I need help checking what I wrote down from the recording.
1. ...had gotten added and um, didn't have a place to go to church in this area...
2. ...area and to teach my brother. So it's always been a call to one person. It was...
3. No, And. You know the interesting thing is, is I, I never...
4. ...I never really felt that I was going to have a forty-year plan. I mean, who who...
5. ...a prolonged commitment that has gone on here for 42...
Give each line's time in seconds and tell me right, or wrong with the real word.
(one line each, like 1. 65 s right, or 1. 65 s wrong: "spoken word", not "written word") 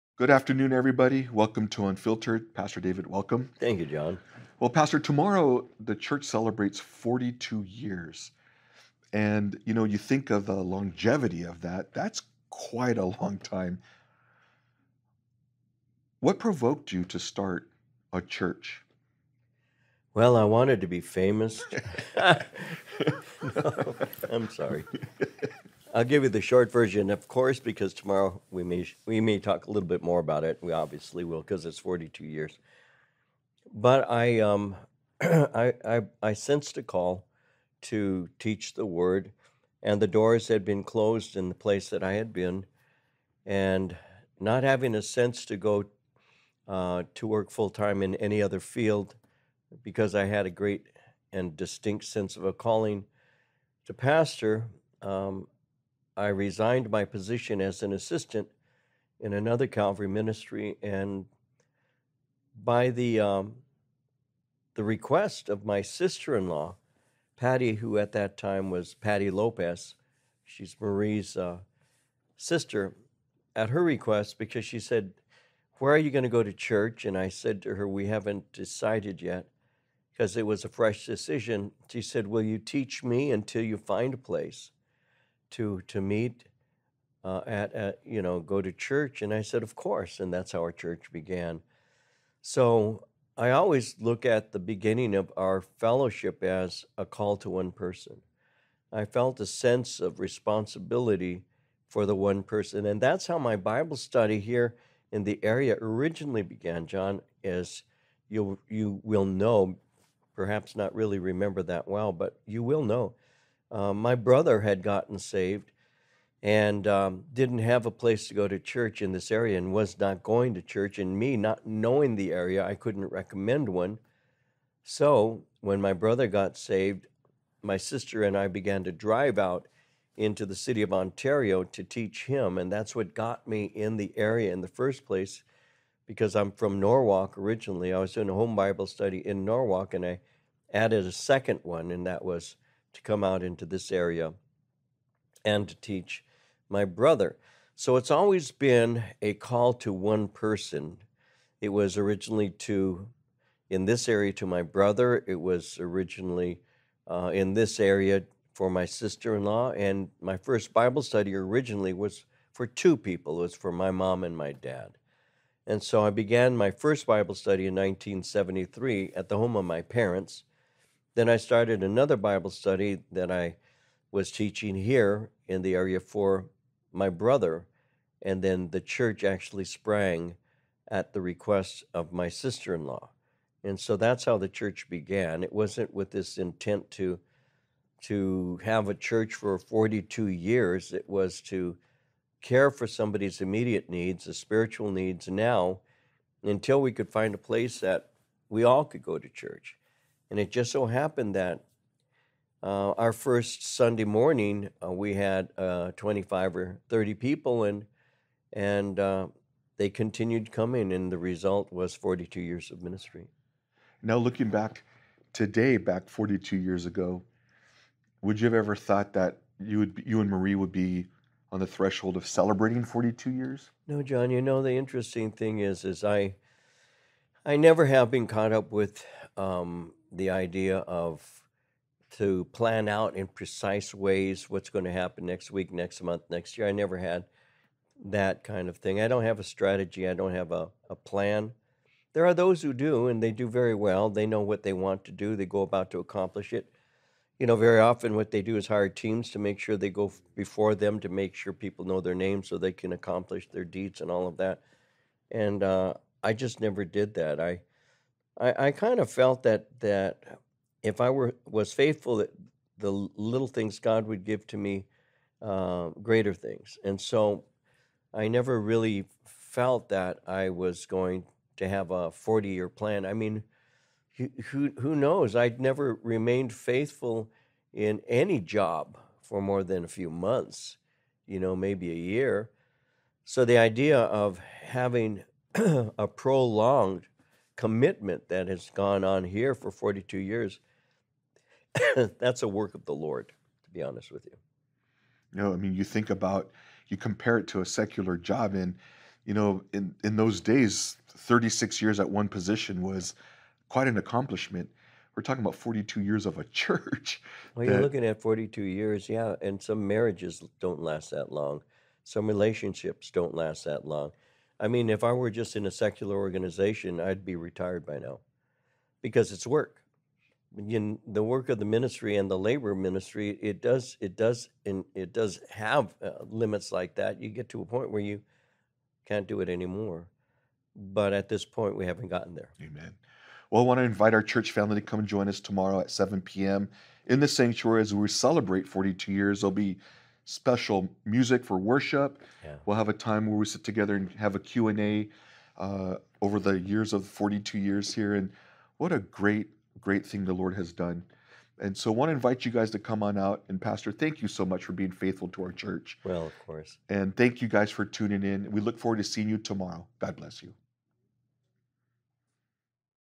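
1. 114 s wrong: "saved", not "added"
2. 143 s right
3. 223 s wrong: "John", not "And"
4. 268 s right
5. 285 s right.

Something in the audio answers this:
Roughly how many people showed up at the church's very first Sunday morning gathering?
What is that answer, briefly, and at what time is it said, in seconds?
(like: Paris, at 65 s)
25 or 30, at 205 s.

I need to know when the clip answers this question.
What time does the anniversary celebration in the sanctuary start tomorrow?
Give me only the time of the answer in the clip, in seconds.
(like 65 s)
335 s.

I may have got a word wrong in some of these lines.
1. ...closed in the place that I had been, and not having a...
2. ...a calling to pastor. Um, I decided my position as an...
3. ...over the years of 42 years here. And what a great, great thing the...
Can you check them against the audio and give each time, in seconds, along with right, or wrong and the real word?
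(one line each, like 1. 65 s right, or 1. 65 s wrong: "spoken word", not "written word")
1. 40 s right
2. 52 s wrong: "resigned", not "decided"
3. 346 s right.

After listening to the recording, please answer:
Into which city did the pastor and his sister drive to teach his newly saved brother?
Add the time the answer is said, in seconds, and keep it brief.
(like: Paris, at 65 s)
Ontario, at 130 s.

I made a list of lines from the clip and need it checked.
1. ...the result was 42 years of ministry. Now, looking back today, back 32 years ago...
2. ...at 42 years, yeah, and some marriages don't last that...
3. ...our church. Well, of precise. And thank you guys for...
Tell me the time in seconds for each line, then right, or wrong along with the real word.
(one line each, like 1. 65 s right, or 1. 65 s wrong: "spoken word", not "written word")
1. 211 s wrong: "42", not "32"
2. 308 s right
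3. 355 s wrong: "course", not "precise".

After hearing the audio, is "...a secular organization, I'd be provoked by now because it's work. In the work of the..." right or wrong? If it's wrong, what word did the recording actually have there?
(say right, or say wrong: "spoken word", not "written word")
wrong: "retired", not "provoked".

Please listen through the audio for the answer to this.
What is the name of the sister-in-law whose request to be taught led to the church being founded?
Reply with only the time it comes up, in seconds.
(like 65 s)
68 s.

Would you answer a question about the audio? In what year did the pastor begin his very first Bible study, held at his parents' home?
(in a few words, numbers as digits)
1973.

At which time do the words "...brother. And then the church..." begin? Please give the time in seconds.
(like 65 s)
177 s.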